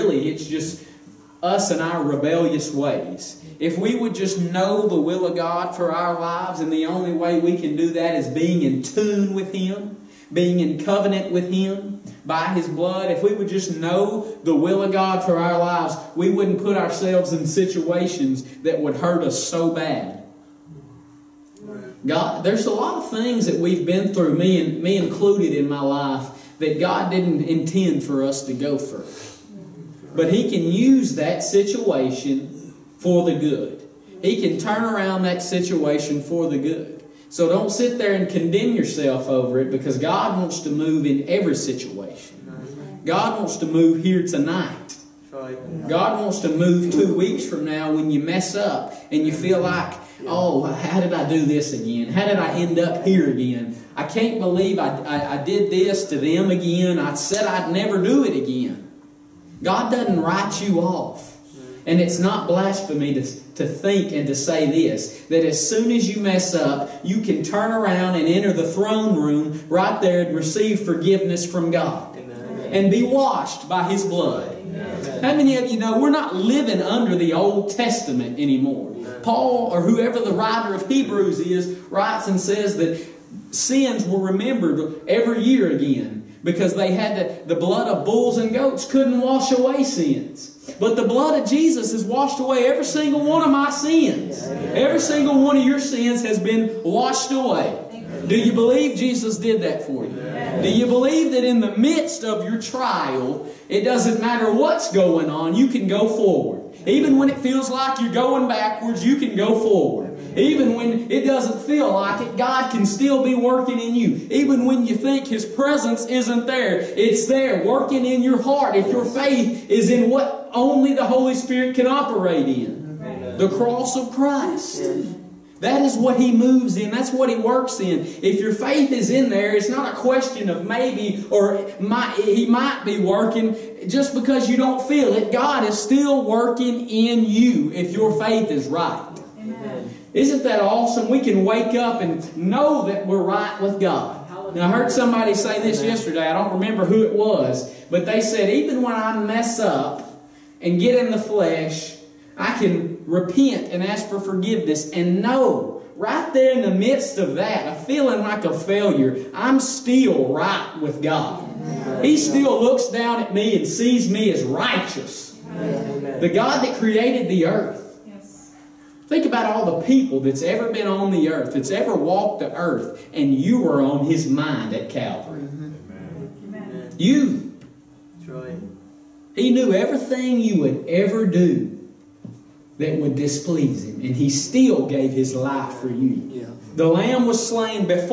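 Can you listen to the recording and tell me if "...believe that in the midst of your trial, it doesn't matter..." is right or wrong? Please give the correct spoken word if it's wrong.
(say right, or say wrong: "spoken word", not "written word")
right.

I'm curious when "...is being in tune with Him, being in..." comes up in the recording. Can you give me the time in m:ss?
0:08.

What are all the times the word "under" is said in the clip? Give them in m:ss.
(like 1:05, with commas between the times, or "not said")
1:16.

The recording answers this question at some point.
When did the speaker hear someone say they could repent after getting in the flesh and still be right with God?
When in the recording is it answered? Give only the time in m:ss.
2:25.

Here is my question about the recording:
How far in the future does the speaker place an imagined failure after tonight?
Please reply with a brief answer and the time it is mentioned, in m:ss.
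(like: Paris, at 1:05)
2 weeks, at 0:46.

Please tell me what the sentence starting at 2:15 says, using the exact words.
God is still working in you if your faith is right.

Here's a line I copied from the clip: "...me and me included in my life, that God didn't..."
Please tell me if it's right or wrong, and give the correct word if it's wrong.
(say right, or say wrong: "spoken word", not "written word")
right.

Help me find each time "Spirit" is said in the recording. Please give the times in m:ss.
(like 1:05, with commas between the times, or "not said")
2:01.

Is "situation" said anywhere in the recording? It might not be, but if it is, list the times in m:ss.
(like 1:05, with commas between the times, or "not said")
0:17, 0:31, 0:35, 0:41.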